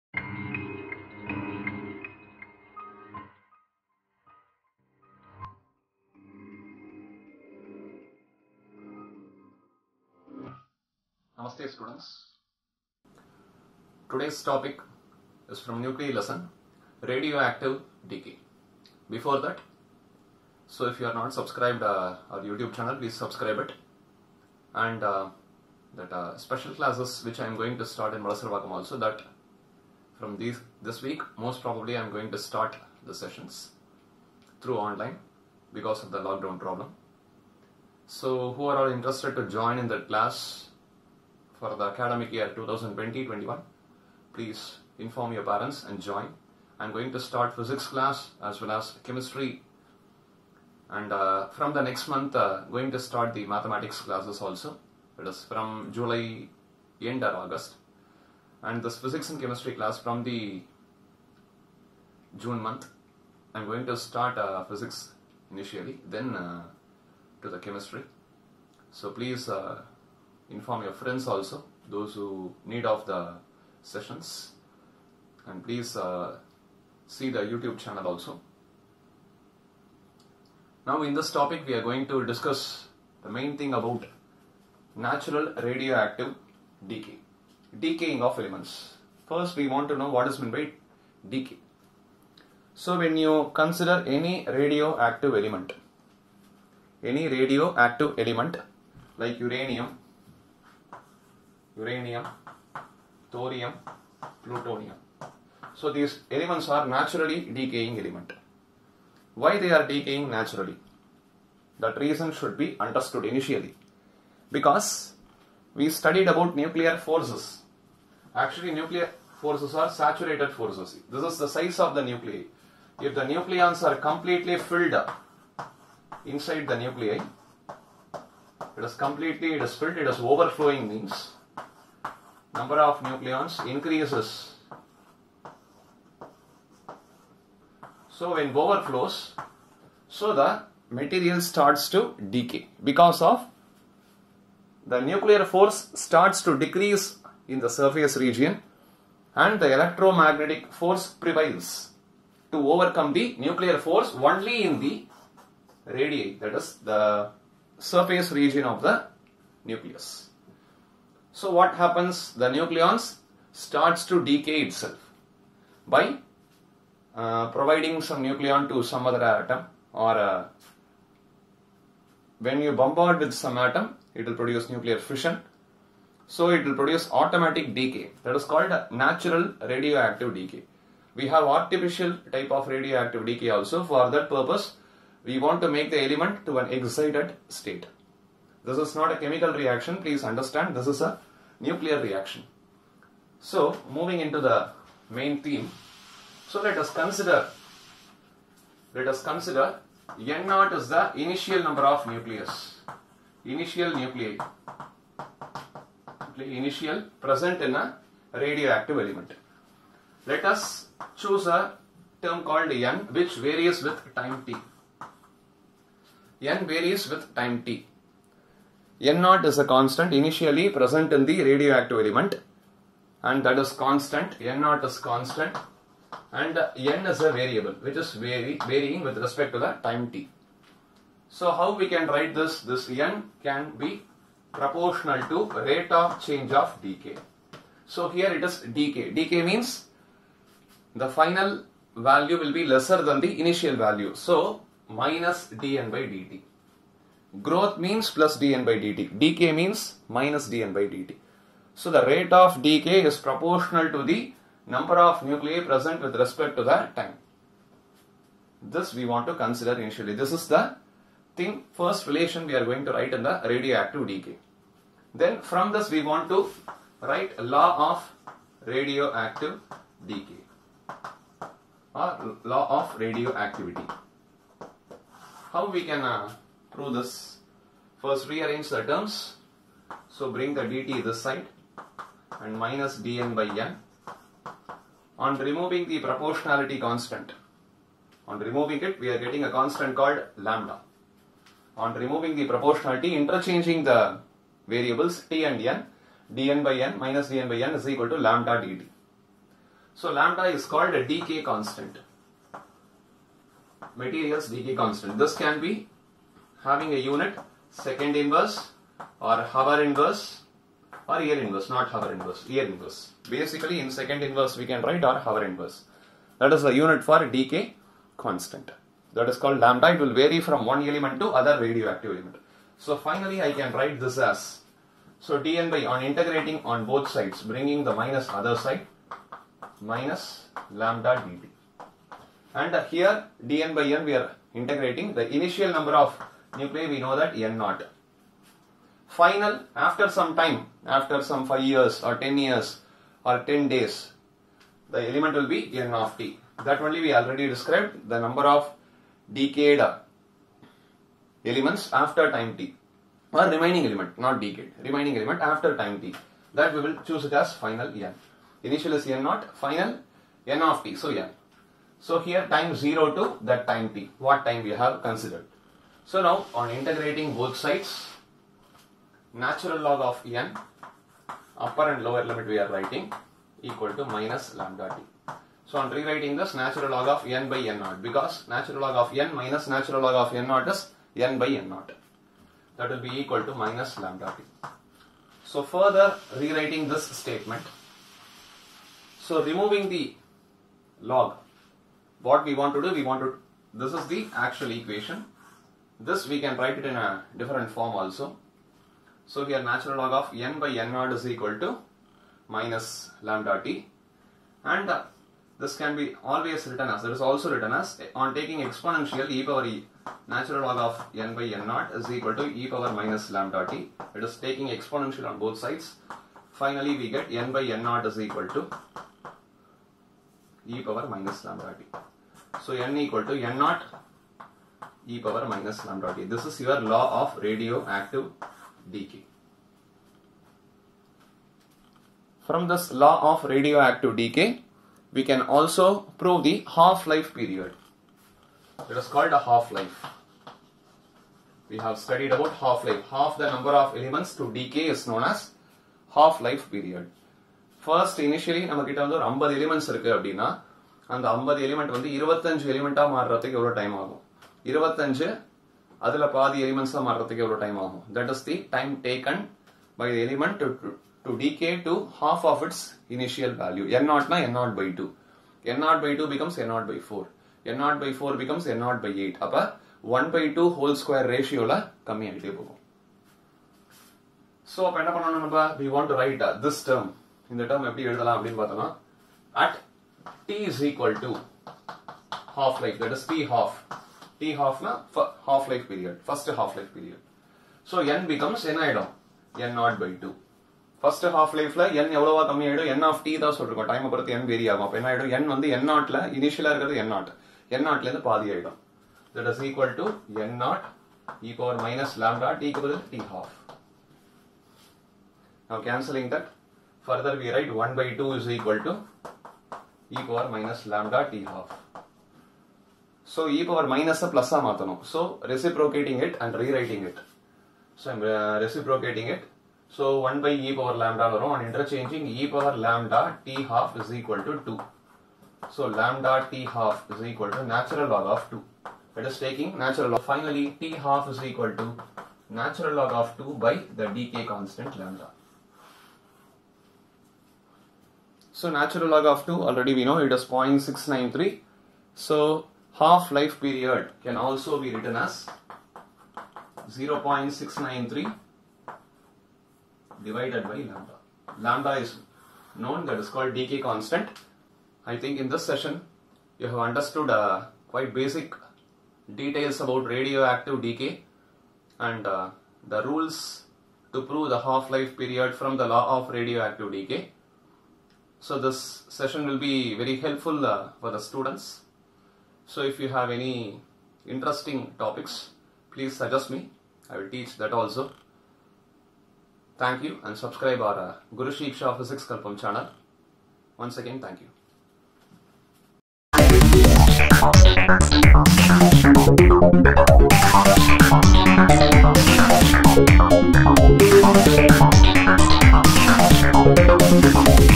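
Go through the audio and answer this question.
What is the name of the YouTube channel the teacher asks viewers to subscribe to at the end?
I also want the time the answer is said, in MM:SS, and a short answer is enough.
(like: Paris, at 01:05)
Guru Shiksha Physics Kalpam, at 09:41.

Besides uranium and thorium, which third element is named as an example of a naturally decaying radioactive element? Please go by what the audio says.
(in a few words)
Plutonium.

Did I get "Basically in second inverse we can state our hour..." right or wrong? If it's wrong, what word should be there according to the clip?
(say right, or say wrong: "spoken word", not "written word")
wrong: "write", not "state".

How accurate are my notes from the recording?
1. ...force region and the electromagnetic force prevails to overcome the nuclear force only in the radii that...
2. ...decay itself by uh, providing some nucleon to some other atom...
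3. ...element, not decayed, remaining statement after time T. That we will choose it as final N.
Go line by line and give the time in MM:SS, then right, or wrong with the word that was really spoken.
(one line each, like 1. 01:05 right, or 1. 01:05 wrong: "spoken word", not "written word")
1. 02:27 wrong: "surface", not "force"
2. 02:44 right
3. 05:53 wrong: "element", not "statement".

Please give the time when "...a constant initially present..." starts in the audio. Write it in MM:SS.
03:39.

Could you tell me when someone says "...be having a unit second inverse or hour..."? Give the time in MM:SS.
05:05.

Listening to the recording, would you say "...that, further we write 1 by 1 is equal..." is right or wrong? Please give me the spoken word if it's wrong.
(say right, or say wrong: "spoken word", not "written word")
wrong: "2", not "1".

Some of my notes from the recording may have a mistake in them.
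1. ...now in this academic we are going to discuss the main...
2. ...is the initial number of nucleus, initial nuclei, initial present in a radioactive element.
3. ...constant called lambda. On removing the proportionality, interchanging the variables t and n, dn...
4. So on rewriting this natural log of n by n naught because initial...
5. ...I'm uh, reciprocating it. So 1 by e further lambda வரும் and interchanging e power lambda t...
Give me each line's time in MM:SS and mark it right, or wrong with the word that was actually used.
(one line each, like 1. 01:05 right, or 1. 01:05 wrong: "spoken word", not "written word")
1. 01:20 wrong: "topic", not "academic"
2. 03:20 right
3. 04:49 right
4. 06:15 wrong: "natural", not "initial"
5. 08:38 wrong: "power", not "further".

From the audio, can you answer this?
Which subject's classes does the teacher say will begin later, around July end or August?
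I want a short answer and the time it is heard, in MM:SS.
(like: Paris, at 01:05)
Mathematics, at 00:53.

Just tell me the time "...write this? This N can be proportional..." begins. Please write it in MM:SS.
03:52.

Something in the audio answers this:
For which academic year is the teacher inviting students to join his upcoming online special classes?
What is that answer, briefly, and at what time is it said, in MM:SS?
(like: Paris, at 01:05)
2020-21, at 00:42.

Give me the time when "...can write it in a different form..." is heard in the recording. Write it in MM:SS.
06:36.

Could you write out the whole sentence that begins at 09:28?
So this session will be very helpful uh, for the students.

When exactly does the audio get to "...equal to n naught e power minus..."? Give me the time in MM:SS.
07:02.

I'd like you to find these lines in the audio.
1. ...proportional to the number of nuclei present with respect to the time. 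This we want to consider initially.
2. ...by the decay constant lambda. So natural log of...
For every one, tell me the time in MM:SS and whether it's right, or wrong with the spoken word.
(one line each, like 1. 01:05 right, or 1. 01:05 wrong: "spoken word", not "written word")
1. 04:13 right
2. 08:53 right.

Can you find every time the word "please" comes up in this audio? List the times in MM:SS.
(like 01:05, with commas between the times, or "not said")
00:22, 00:44, 01:09, 01:15, 03:09, 09:35.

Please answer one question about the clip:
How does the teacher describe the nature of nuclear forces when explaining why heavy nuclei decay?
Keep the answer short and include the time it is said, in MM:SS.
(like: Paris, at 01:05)
Saturated forces, at 01:59.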